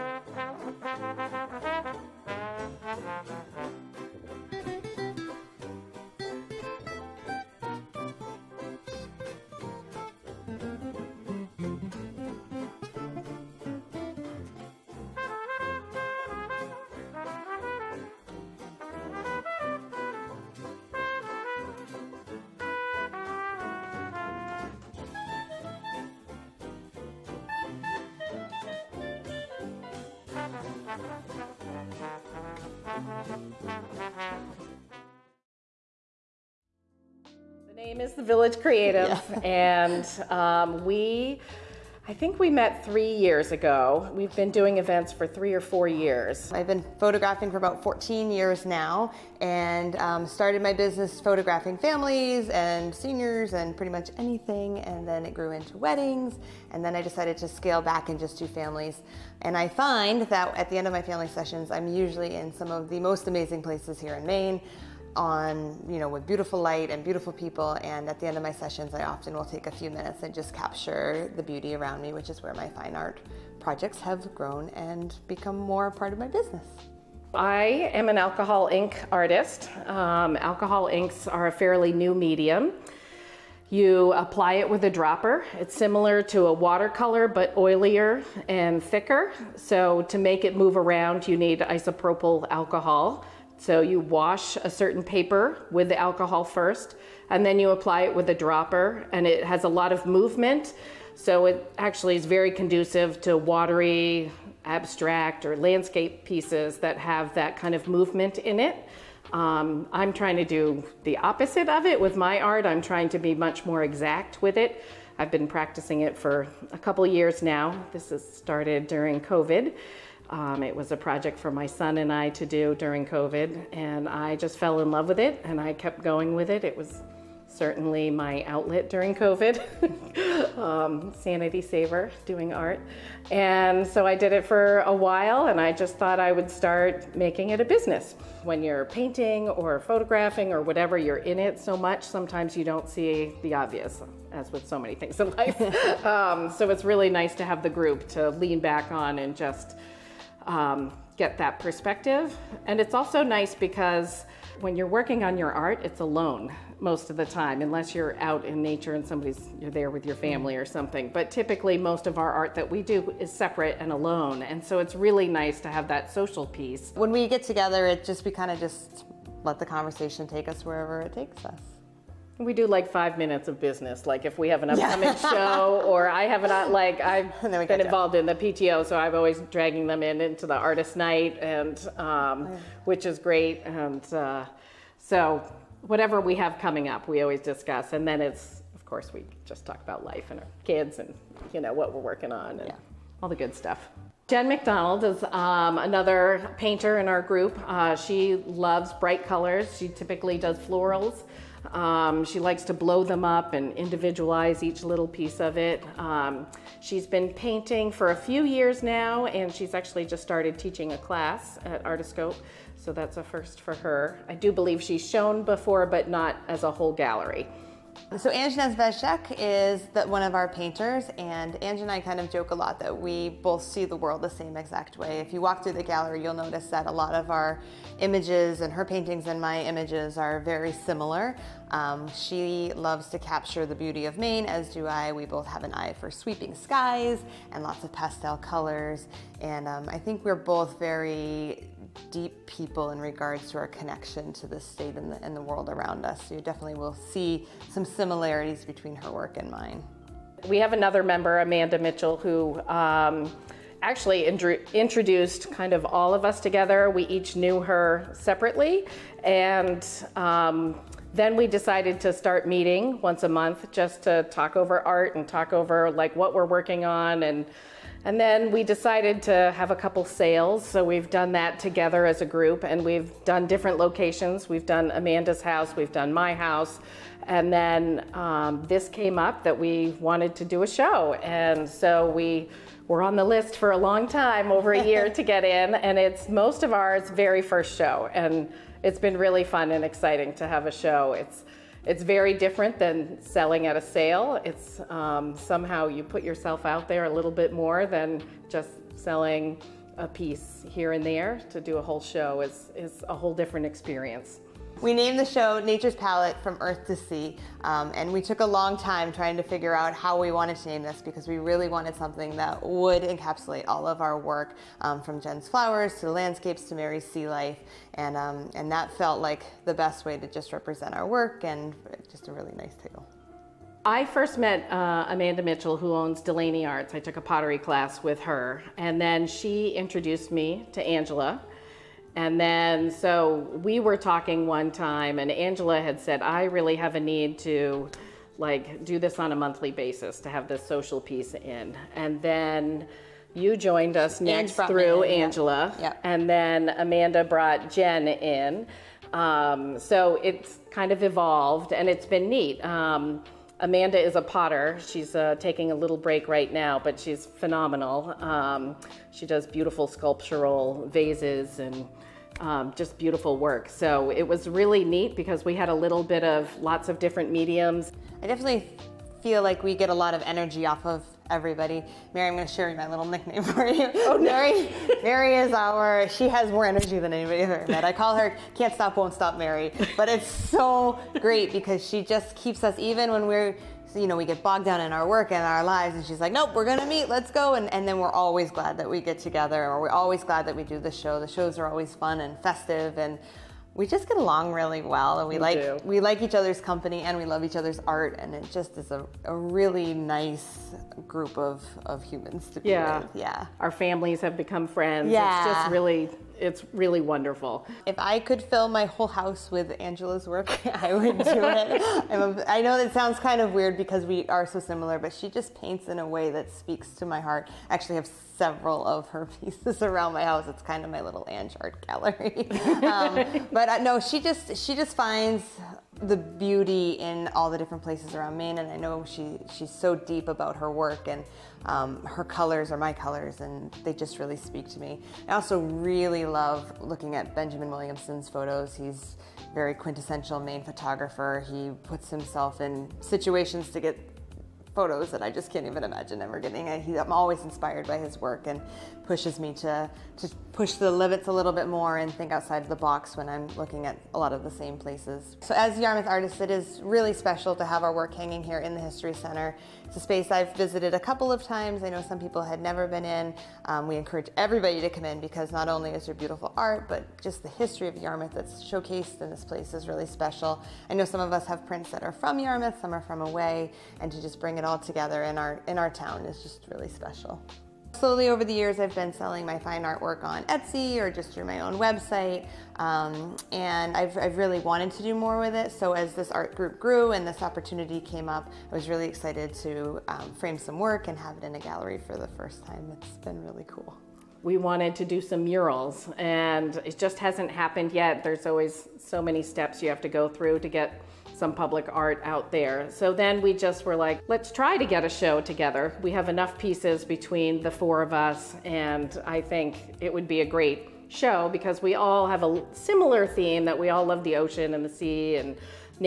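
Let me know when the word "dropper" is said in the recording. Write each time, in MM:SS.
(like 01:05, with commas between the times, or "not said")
01:24, 01:38.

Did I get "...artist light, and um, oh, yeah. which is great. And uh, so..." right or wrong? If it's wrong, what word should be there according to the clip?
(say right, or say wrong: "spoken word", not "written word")
wrong: "night", not "light".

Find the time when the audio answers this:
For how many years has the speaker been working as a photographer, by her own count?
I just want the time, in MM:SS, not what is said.
00:47.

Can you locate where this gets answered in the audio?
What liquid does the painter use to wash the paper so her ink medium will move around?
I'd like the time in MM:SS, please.
01:31.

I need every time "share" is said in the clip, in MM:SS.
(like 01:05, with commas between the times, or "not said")
06:12.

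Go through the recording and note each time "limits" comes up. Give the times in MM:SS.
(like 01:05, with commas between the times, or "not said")
07:30.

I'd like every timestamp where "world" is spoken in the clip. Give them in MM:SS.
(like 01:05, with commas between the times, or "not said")
03:43, 04:05.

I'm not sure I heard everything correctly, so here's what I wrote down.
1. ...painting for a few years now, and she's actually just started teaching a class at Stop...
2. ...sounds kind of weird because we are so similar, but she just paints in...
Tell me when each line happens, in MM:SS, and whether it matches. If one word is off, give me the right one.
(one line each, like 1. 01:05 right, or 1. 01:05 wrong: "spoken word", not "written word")
1. 03:27 wrong: "Artiscope", not "Stop"
2. 06:52 right.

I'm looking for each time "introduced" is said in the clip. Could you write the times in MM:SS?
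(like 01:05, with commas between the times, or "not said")
04:14, 05:29.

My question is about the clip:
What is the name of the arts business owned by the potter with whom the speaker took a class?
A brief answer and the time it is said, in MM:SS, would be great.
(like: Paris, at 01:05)
Delaney Arts, at 05:26.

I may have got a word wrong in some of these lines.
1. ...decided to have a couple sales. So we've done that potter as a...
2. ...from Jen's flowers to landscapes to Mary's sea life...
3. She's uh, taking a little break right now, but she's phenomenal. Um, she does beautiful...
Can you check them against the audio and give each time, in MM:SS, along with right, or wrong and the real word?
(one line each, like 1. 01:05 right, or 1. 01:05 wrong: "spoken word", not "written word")
1. 04:28 wrong: "together", not "potter"
2. 05:15 right
3. 05:54 right.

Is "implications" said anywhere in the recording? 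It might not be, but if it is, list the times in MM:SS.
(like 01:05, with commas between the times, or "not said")
not said.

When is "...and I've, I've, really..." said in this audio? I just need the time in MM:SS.
08:03.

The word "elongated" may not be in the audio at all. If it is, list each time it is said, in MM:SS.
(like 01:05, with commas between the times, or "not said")
not said.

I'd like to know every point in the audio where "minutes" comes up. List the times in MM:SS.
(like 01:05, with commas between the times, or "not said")
01:09, 02:53.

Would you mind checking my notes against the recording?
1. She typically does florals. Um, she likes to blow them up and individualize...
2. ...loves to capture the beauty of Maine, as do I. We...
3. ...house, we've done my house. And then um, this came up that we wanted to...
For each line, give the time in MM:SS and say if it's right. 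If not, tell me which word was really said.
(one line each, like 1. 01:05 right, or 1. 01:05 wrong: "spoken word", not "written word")
1. 03:19 right
2. 03:52 right
3. 04:35 right.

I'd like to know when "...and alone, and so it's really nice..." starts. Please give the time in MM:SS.
02:43.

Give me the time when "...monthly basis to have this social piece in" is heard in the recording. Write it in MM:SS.
05:39.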